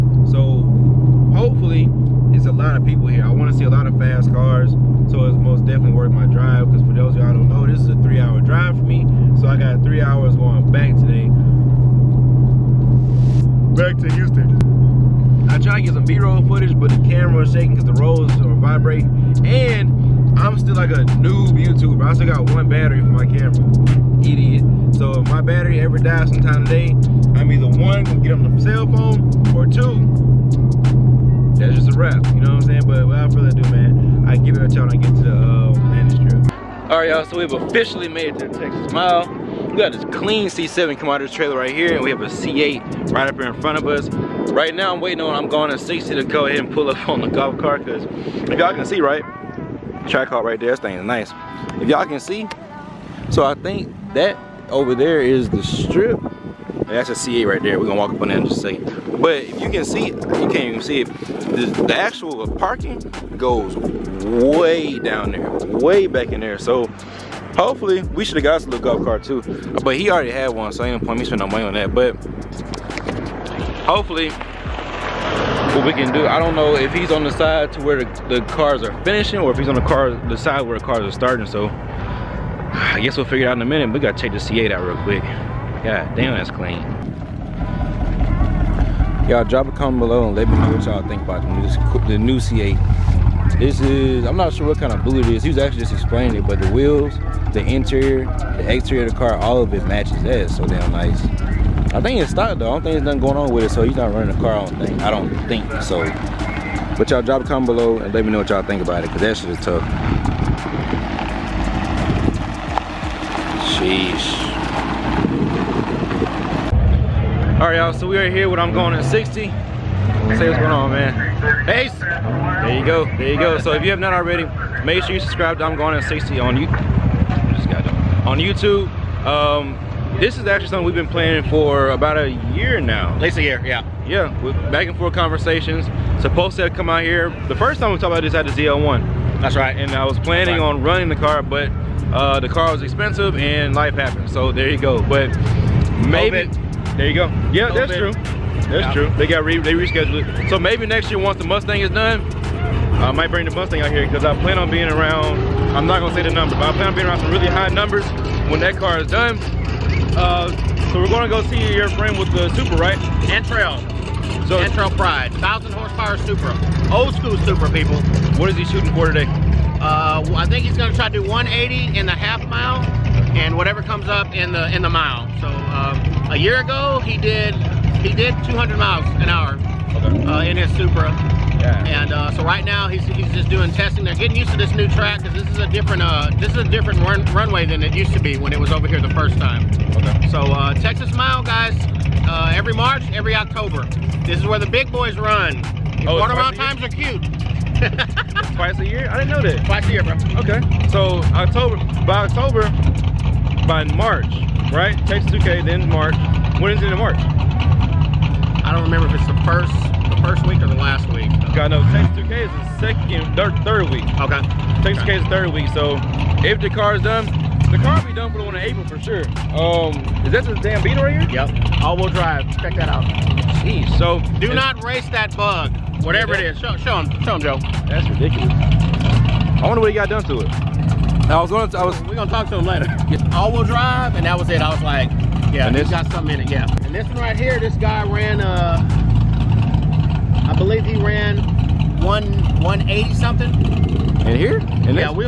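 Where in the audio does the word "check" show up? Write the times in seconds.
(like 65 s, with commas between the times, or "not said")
84 s, 222 s.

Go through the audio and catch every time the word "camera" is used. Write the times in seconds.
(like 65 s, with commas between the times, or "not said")
17 s, 23 s.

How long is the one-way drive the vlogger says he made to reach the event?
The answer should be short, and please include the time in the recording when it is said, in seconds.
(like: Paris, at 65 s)
3 hours, at 7 s.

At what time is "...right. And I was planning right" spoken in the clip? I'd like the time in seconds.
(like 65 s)
139 s.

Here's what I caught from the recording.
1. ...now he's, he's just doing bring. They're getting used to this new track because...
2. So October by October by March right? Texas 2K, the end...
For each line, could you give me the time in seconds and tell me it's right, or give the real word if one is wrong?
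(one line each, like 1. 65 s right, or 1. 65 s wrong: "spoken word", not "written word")
1. 182 s wrong: "testing", not "bring"
2. 200 s right.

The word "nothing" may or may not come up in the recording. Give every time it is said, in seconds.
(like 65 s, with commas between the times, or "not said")
103 s.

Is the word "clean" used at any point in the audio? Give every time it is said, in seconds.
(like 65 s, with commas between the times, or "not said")
40 s, 86 s.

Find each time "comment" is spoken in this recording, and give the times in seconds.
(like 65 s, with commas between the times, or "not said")
89 s, 107 s.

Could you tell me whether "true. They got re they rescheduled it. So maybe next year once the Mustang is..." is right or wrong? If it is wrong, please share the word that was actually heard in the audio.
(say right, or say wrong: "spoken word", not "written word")
right.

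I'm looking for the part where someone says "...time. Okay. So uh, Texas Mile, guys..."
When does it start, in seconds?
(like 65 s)
189 s.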